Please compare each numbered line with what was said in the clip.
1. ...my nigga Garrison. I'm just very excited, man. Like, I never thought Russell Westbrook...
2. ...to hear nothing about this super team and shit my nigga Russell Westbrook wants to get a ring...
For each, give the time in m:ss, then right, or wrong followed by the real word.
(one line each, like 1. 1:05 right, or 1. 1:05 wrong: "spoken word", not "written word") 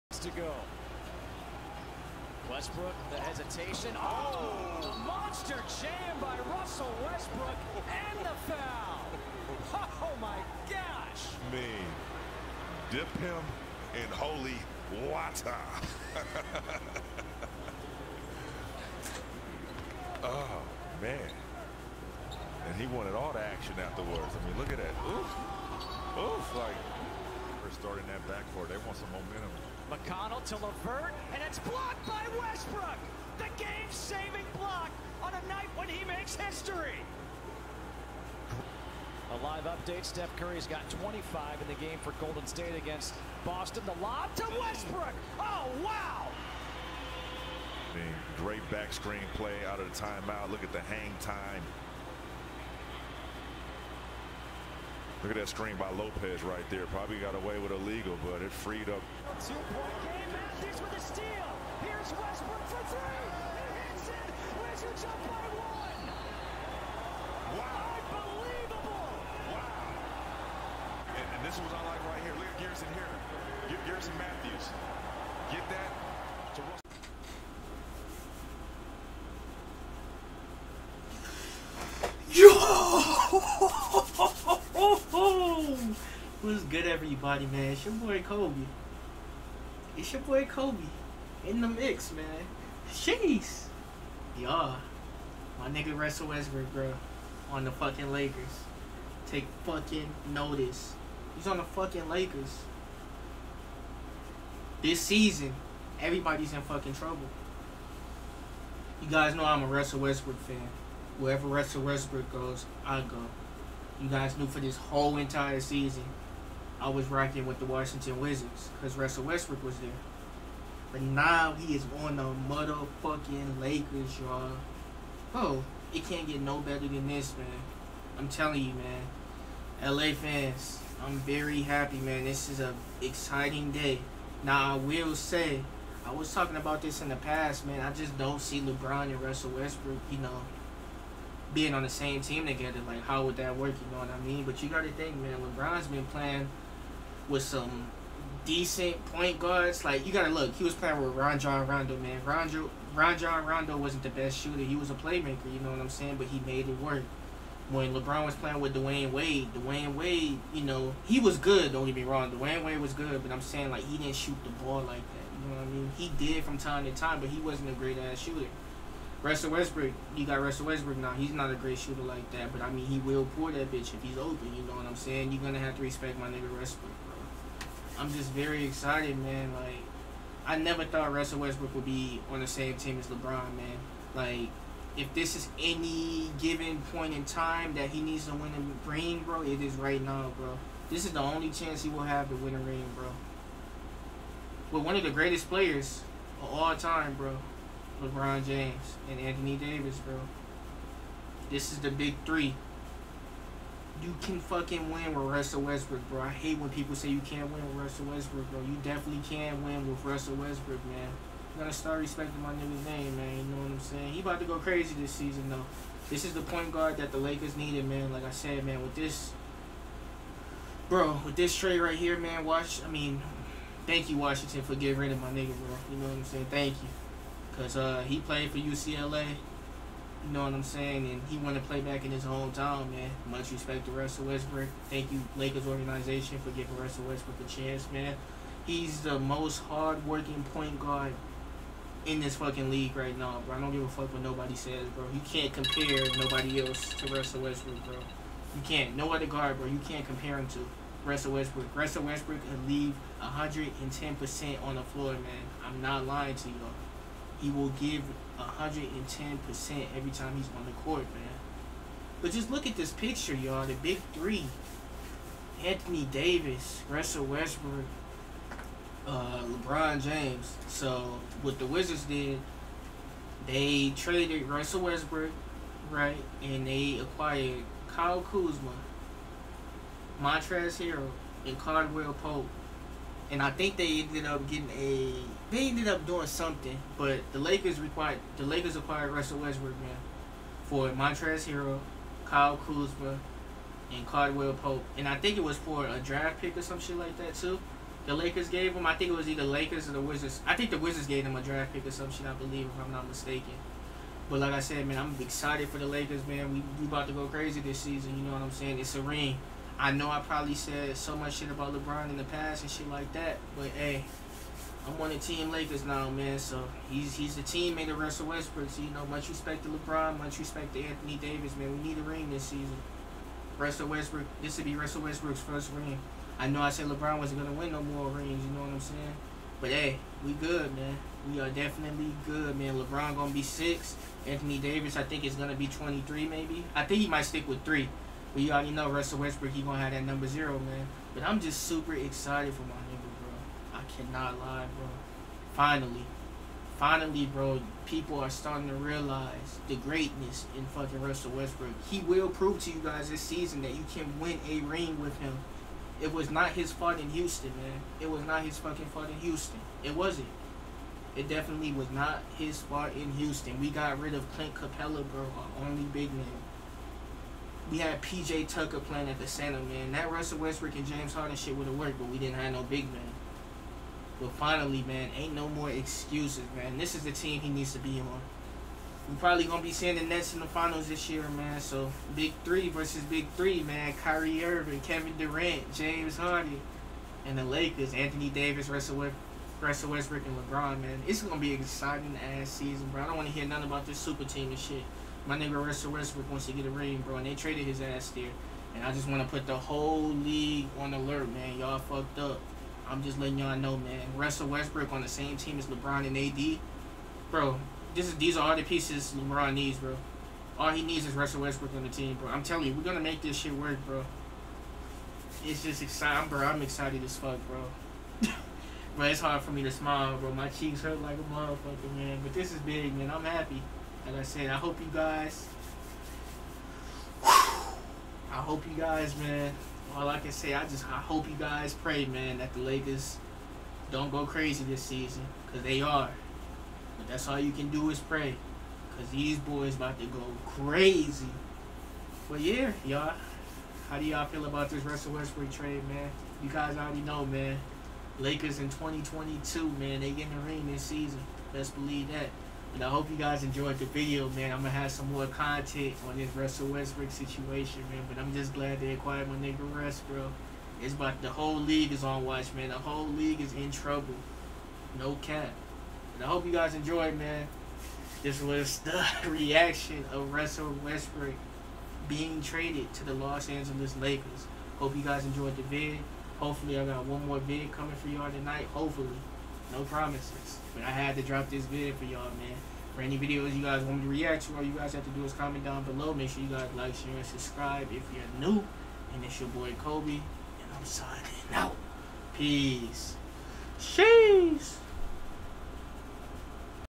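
1. 2:56 wrong: "Westbrook", not "Garrison"
2. 6:33 right.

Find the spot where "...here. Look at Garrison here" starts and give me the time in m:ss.
1:12.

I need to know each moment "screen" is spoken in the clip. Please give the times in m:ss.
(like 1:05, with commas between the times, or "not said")
0:48, 0:55.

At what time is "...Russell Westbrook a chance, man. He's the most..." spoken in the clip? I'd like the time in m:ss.
3:56.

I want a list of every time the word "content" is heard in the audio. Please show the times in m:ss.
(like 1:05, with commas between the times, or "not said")
7:35.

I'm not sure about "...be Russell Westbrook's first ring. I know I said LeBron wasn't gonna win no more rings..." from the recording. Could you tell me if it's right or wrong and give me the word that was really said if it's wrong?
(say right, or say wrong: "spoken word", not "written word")
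right.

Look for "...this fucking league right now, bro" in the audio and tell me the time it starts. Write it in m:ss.
4:02.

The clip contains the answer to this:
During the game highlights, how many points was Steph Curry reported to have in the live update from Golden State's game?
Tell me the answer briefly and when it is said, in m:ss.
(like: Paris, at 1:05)
25, at 0:41.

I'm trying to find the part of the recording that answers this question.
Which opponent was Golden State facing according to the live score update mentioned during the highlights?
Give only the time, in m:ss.
0:43.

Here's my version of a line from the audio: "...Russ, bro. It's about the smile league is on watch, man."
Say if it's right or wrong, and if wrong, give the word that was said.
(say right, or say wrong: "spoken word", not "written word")
wrong: "whole", not "smile".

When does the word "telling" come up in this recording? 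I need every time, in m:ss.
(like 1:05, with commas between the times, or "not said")
2:08, 6:52.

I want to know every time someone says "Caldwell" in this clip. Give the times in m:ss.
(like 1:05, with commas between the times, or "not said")
4:41, 4:54.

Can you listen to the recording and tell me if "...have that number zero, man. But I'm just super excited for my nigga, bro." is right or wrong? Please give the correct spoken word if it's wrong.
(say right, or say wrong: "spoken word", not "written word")
right.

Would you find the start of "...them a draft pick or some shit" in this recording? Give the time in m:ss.
5:01.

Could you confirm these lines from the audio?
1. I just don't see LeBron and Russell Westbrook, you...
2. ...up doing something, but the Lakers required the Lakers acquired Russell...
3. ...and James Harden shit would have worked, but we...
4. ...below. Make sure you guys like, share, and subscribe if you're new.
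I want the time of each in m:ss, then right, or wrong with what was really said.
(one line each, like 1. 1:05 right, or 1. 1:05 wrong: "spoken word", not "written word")
1. 2:17 right
2. 4:45 right
3. 6:10 right
4. 8:05 right.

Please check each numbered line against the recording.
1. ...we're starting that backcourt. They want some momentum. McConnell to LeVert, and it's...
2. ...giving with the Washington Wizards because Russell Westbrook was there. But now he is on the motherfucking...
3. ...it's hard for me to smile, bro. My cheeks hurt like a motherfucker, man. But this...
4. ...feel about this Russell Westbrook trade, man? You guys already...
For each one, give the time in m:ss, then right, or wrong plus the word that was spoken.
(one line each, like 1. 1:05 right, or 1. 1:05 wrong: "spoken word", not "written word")
1. 0:27 right
2. 1:57 wrong: "rocking", not "giving"
3. 6:59 right
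4. 7:24 right.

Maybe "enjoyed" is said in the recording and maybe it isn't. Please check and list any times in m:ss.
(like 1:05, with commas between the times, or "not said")
7:33, 7:46, 7:55.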